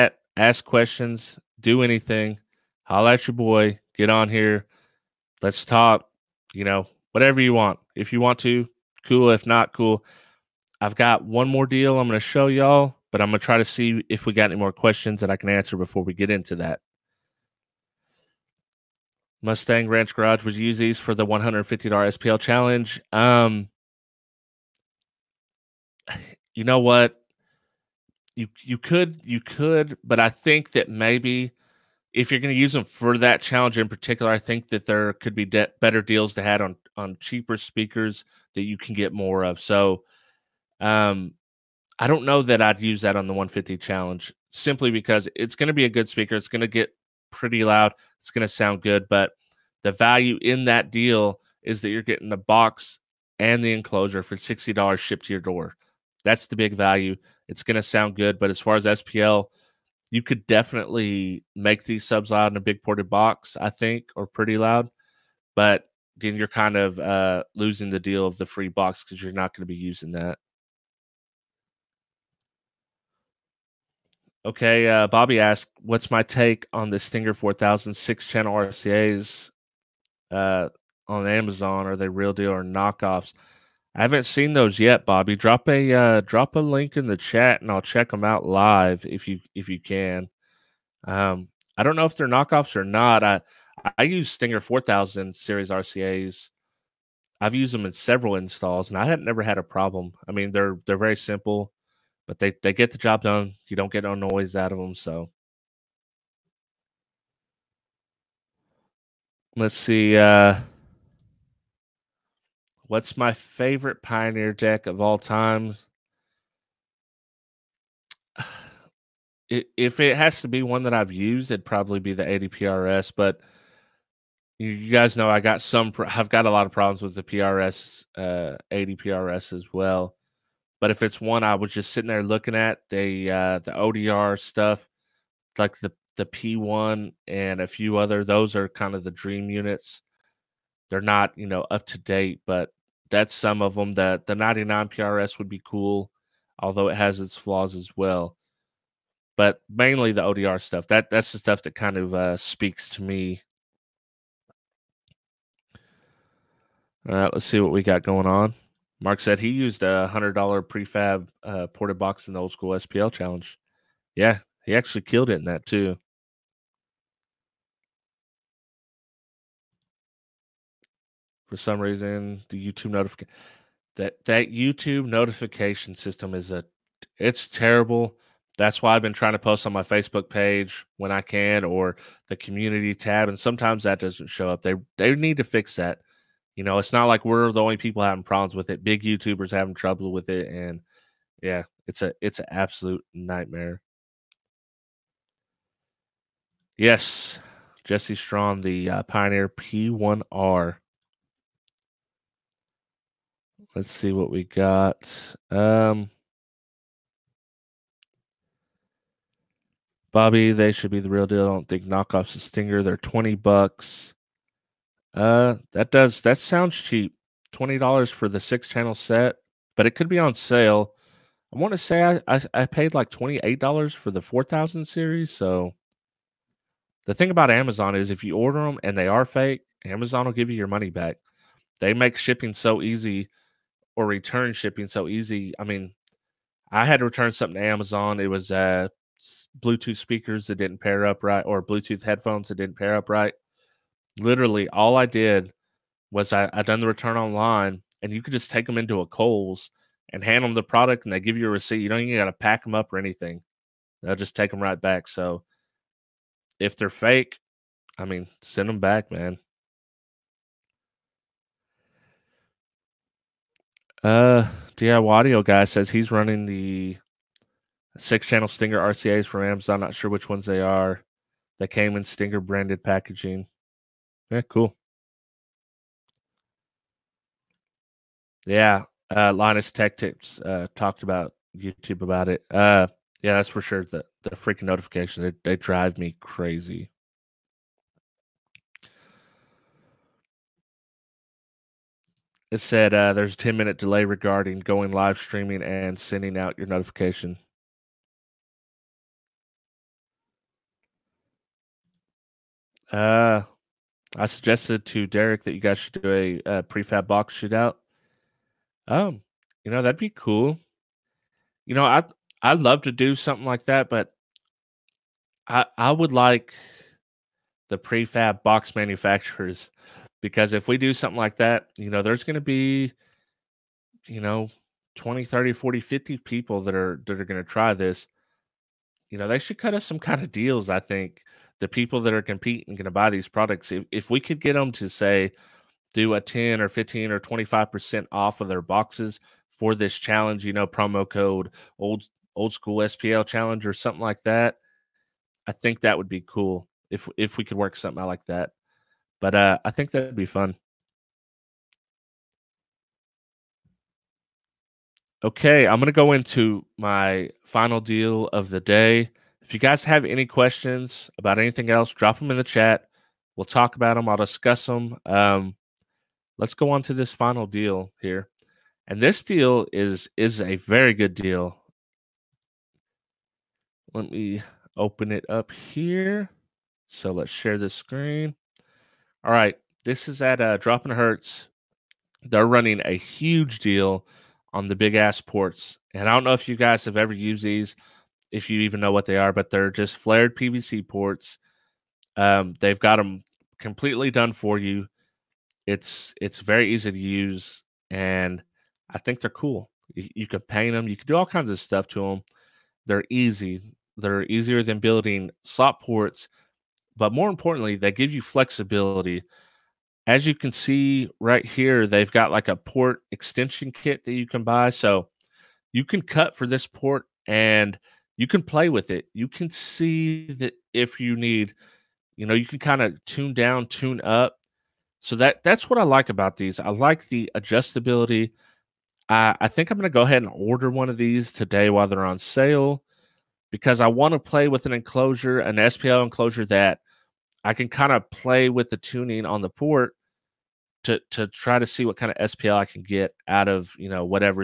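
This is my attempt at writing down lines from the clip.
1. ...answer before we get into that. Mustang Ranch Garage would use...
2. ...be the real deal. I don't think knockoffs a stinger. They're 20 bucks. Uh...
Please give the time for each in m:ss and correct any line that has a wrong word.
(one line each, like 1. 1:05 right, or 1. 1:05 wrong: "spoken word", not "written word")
1. 0:15 right
2. 3:30 right.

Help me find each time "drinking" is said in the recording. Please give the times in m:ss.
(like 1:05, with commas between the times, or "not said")
not said.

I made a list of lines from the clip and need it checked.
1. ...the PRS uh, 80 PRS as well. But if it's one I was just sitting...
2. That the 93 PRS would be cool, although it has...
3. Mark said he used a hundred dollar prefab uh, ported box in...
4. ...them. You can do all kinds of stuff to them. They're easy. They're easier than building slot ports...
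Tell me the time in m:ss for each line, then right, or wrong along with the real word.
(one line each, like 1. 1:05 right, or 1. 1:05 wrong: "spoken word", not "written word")
1. 2:07 right
2. 2:23 wrong: "99", not "93"
3. 2:39 right
4. 6:40 right.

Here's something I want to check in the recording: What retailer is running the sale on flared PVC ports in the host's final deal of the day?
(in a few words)
Droppin Hz.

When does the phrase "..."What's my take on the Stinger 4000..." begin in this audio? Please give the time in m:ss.
1:15.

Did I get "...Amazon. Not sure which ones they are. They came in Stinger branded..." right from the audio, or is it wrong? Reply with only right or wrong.
right.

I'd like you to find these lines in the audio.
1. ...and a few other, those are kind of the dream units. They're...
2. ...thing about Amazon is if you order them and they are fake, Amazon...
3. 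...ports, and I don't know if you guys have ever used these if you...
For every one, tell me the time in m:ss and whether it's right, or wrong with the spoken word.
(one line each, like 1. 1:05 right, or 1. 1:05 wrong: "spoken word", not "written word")
1. 2:17 right
2. 3:47 right
3. 6:25 right.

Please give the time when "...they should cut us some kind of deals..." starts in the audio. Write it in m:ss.
5:29.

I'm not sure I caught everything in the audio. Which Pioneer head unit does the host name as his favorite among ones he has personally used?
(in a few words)
80PRS.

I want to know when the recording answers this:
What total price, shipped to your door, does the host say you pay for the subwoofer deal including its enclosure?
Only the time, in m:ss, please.
0:54.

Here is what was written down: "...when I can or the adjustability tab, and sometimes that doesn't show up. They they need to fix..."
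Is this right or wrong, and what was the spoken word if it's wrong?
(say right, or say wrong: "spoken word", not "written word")
wrong: "community", not "adjustability".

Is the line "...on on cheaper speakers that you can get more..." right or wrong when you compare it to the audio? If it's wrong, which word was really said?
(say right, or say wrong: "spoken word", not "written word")
right.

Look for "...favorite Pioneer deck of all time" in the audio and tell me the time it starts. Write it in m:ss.
1:53.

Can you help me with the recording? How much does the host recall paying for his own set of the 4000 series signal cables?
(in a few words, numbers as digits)
$28.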